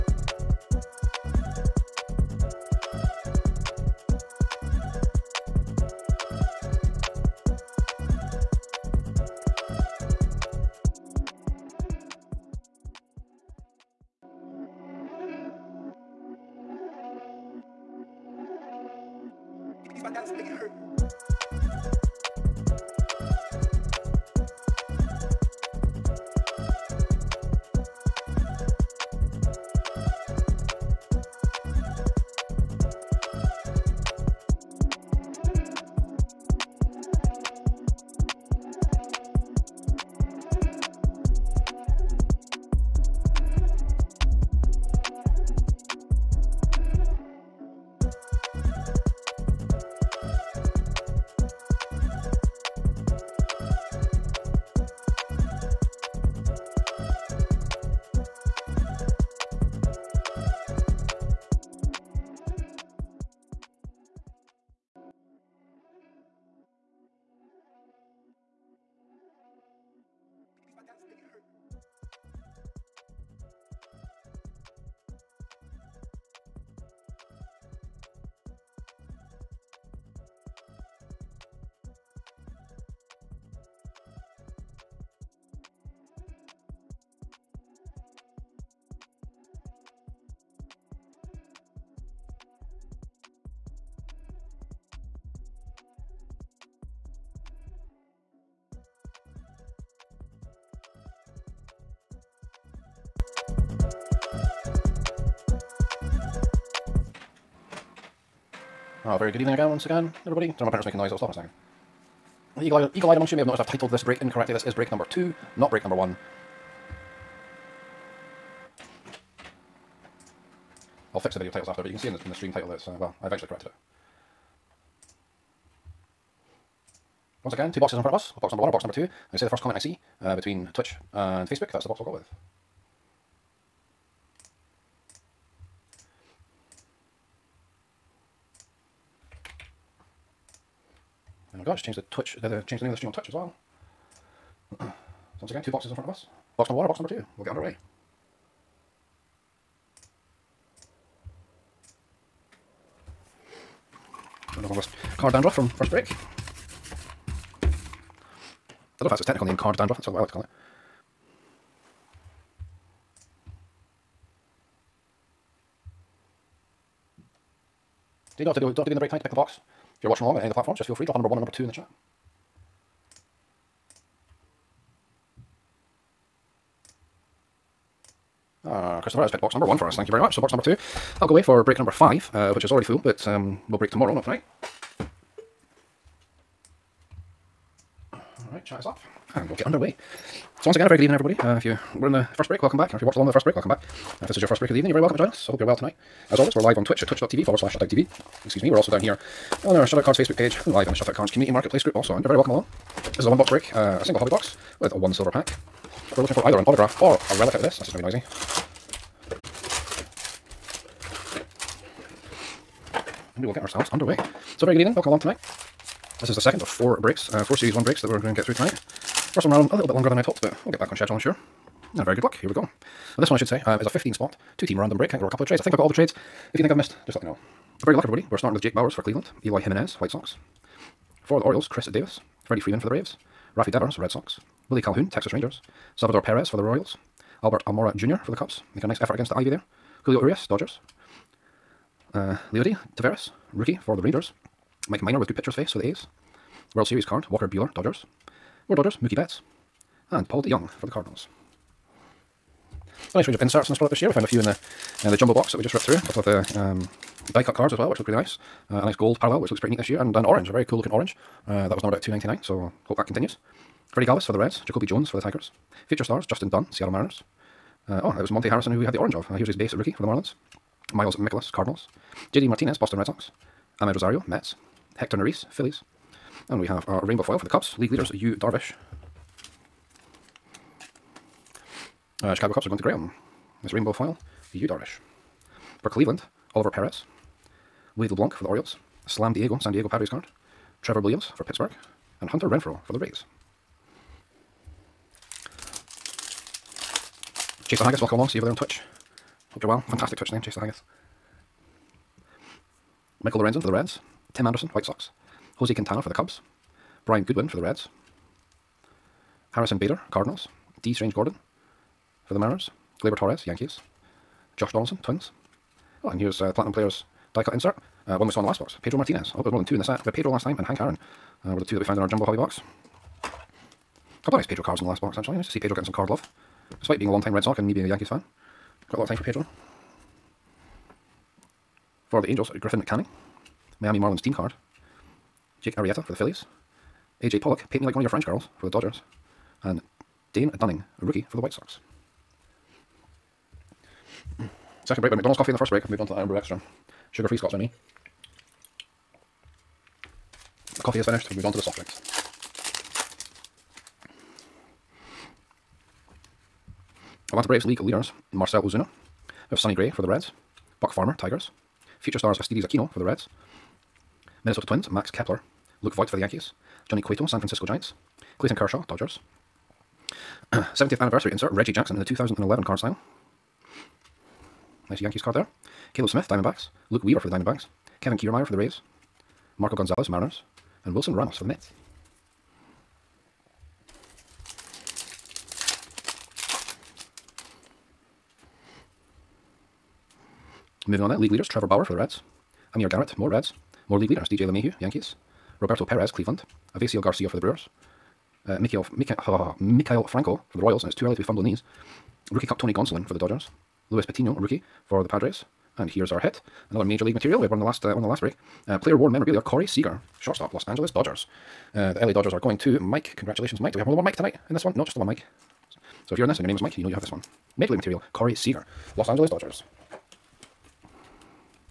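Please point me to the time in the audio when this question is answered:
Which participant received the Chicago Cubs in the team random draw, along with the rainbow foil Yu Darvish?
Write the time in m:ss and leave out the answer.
4:42.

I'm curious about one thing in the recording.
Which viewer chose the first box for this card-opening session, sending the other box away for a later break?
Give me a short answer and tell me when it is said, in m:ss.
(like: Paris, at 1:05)
Christopher, at 2:59.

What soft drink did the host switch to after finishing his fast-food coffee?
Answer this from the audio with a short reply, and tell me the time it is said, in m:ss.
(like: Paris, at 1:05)
Iron Brew Extra, at 5:46.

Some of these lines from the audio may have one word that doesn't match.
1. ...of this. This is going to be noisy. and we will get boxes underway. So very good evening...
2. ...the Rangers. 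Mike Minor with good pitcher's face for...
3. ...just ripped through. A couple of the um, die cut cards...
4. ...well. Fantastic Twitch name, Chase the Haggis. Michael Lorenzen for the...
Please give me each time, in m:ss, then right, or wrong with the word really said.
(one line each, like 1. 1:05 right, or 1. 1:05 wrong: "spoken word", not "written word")
1. 3:27 wrong: "ourselves", not "boxes"
2. 4:03 right
3. 4:15 right
4. 4:59 right.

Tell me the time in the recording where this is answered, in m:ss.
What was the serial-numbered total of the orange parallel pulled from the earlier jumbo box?
4:22.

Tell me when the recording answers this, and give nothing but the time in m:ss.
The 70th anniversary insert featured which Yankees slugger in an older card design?
6:11.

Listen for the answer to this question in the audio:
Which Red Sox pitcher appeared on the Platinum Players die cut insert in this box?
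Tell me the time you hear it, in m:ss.
5:18.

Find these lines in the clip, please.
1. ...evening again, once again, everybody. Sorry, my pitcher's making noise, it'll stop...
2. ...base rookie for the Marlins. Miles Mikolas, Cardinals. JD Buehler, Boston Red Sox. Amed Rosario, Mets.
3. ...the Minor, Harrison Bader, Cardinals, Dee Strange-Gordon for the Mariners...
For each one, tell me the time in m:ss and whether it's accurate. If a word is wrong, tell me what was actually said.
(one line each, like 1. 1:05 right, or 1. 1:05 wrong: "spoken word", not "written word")
1. 1:49 wrong: "printer", not "pitcher"
2. 4:29 wrong: "Martinez", not "Buehler"
3. 5:07 wrong: "Reds", not "Minor".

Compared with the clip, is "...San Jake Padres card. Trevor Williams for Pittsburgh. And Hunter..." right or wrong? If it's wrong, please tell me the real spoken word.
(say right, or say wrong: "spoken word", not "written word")
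wrong: "Diego", not "Jake".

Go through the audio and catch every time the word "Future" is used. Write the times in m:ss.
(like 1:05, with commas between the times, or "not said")
4:25, 6:02.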